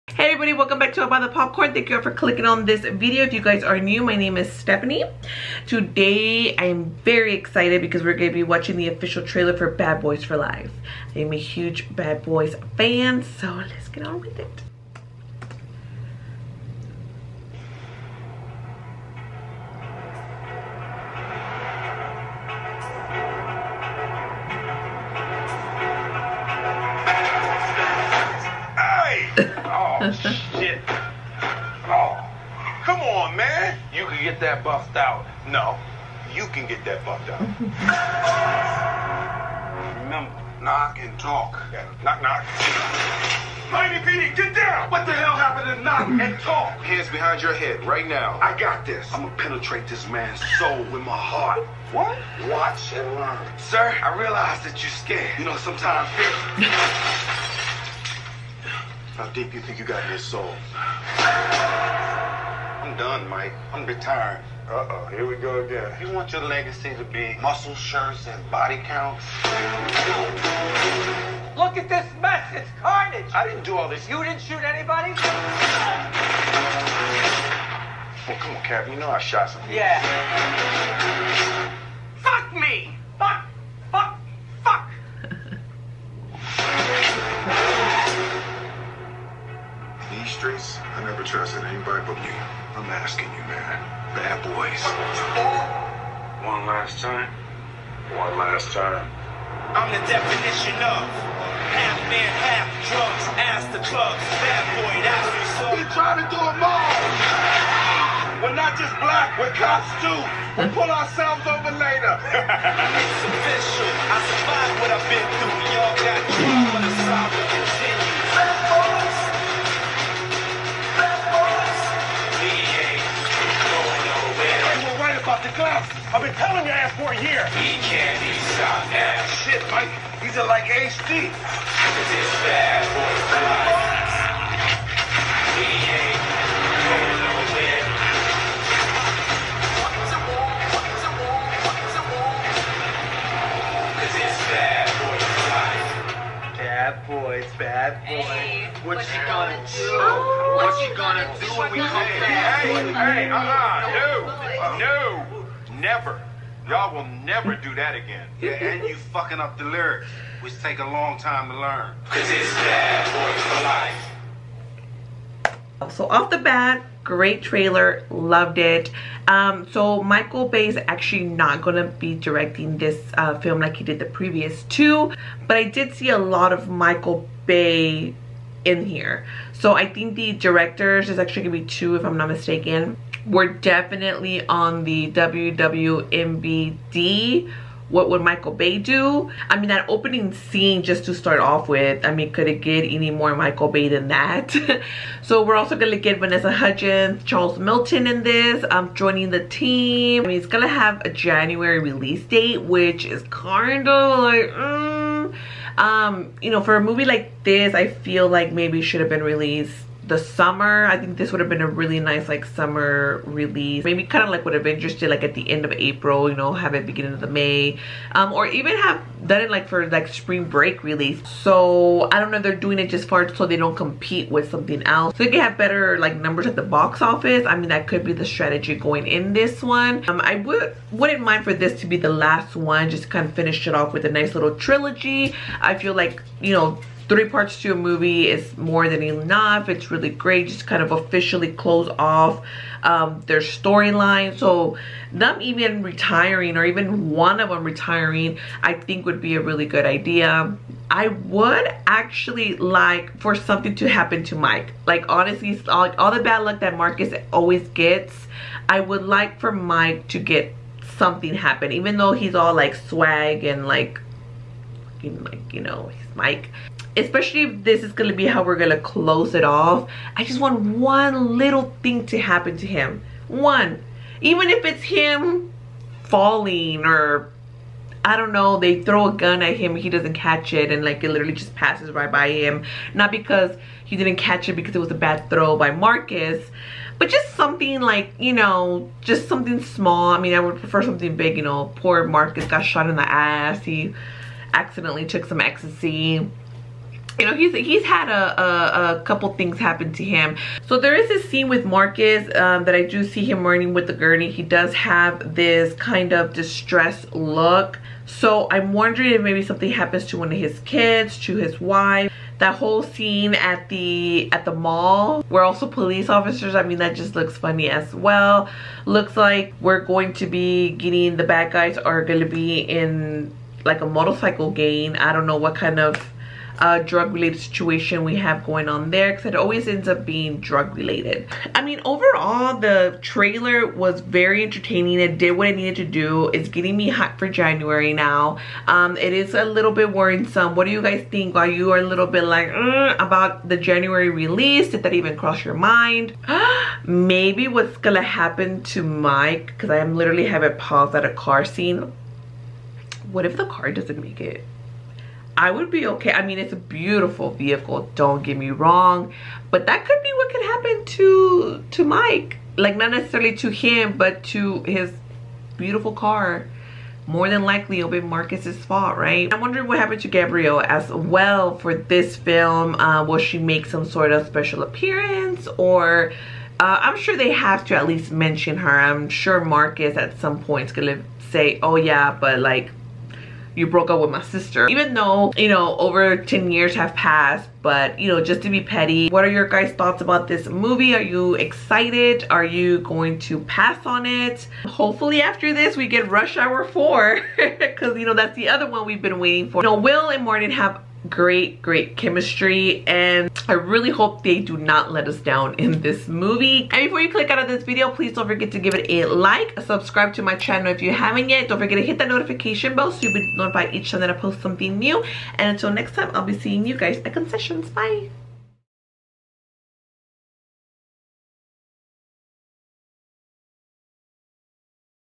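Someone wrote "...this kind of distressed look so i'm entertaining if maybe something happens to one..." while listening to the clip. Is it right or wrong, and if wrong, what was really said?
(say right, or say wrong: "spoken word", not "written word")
wrong: "wondering", not "entertaining".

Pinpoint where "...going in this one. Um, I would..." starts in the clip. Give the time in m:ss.
3:48.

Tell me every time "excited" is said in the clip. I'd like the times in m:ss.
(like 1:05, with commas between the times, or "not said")
0:07, 6:31.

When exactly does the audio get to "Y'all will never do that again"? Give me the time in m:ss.
2:36.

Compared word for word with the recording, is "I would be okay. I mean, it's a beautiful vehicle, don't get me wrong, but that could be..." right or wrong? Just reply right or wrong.
right.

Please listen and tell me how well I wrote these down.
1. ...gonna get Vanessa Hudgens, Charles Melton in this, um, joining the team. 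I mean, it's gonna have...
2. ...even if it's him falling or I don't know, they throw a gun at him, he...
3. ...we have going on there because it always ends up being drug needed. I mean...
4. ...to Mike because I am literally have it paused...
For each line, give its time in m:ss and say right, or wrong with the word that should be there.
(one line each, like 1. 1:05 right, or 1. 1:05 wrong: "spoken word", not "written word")
1. 3:15 right
2. 4:34 right
3. 5:28 wrong: "related", not "needed"
4. 5:48 right.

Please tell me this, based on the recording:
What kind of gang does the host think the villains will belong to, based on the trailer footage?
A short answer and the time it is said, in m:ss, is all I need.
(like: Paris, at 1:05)
motorcycle gang, at 5:23.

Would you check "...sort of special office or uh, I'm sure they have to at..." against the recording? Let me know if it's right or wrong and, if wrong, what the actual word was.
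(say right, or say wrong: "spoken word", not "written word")
wrong: "appearance", not "office".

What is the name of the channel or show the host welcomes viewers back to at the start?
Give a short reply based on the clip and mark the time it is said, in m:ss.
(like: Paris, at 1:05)
I'll Buy the Popcorn, at 0:01.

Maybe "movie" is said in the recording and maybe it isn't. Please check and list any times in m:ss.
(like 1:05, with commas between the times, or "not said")
3:26, 3:57, 6:30, 6:46.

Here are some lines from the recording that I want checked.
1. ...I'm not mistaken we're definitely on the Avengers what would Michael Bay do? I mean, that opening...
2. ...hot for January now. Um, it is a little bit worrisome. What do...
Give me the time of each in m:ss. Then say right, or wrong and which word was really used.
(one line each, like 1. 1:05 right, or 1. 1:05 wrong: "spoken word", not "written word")
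1. 3:02 wrong: "WWMBD", not "Avengers"
2. 5:36 right.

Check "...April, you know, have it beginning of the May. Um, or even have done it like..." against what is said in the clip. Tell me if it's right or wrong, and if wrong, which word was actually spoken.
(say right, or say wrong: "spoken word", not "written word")
right.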